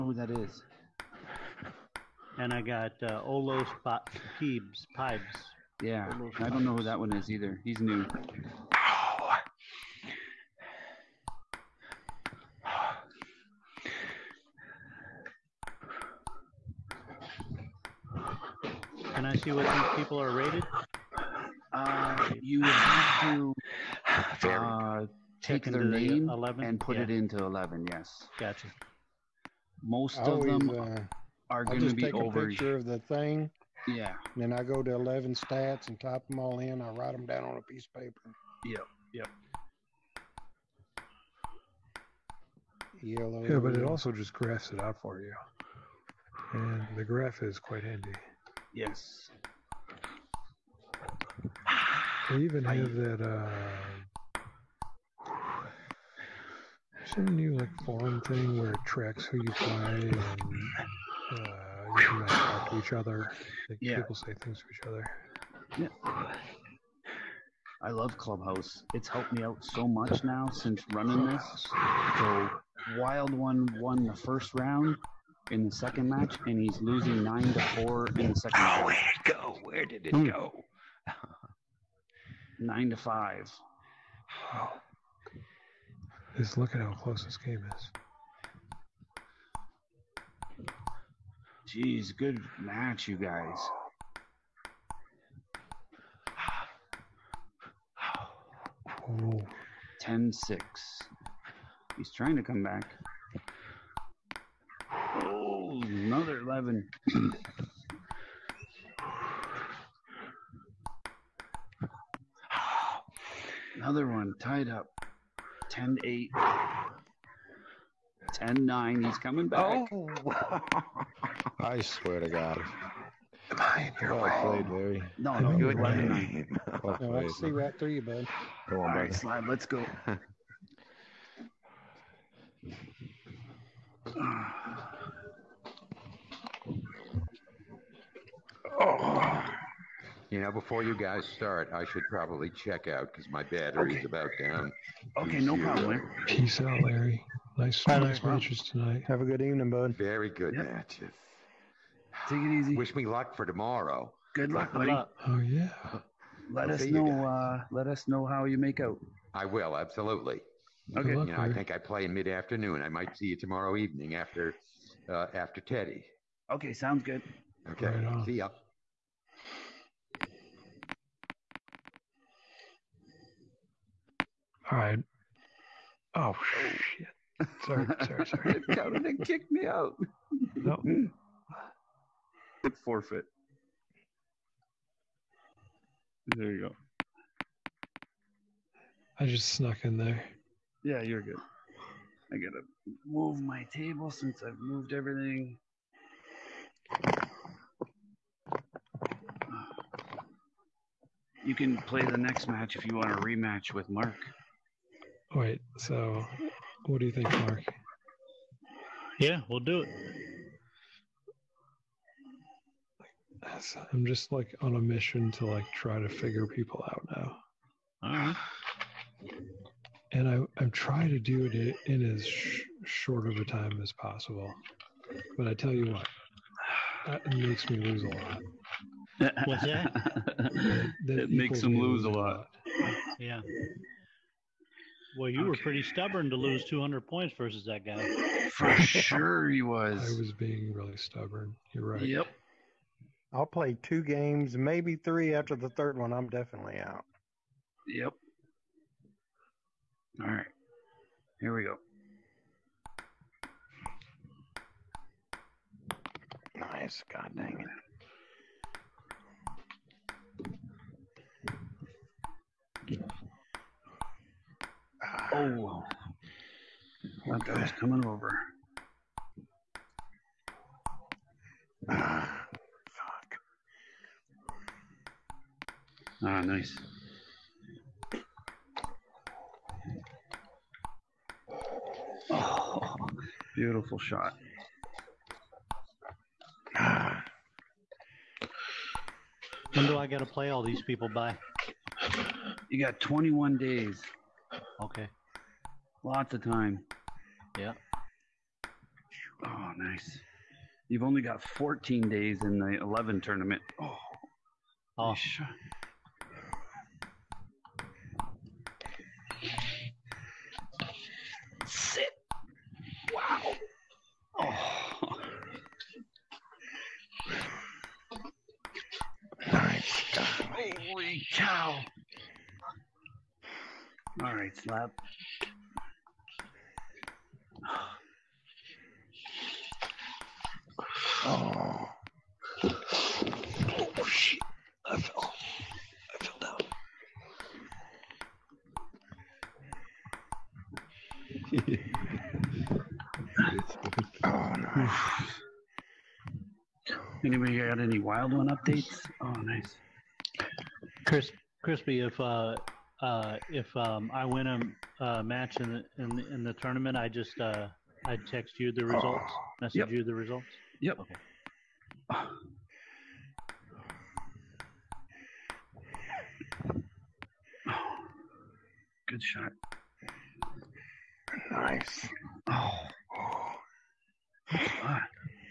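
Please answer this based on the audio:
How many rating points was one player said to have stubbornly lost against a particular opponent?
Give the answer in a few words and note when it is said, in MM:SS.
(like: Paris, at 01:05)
200, at 03:56.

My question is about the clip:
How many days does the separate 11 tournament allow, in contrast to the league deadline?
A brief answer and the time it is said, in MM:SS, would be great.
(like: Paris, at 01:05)
14 days, at 05:01.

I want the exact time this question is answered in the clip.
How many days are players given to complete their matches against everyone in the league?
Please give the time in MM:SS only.
04:52.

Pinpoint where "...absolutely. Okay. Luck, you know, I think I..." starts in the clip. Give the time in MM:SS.
02:39.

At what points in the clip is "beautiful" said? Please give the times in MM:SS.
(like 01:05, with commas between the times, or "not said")
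04:43.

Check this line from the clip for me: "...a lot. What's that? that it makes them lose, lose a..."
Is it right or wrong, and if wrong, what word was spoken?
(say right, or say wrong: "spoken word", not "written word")
right.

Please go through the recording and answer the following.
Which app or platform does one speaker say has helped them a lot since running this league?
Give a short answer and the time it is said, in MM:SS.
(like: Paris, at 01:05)
Clubhouse, at 01:08.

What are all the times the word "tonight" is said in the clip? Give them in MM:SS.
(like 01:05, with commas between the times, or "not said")
02:28.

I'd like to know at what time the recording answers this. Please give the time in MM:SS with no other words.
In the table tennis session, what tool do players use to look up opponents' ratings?
00:34.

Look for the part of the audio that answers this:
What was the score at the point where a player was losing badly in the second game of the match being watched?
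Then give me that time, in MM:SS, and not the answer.
01:17.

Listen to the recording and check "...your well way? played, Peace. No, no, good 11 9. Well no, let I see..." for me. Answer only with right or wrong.
wrong.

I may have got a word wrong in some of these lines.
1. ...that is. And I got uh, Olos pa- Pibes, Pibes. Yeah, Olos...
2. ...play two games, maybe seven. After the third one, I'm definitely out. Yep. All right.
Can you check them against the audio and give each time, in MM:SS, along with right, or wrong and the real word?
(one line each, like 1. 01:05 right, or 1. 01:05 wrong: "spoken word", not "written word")
1. 00:00 right
2. 04:03 wrong: "three", not "seven".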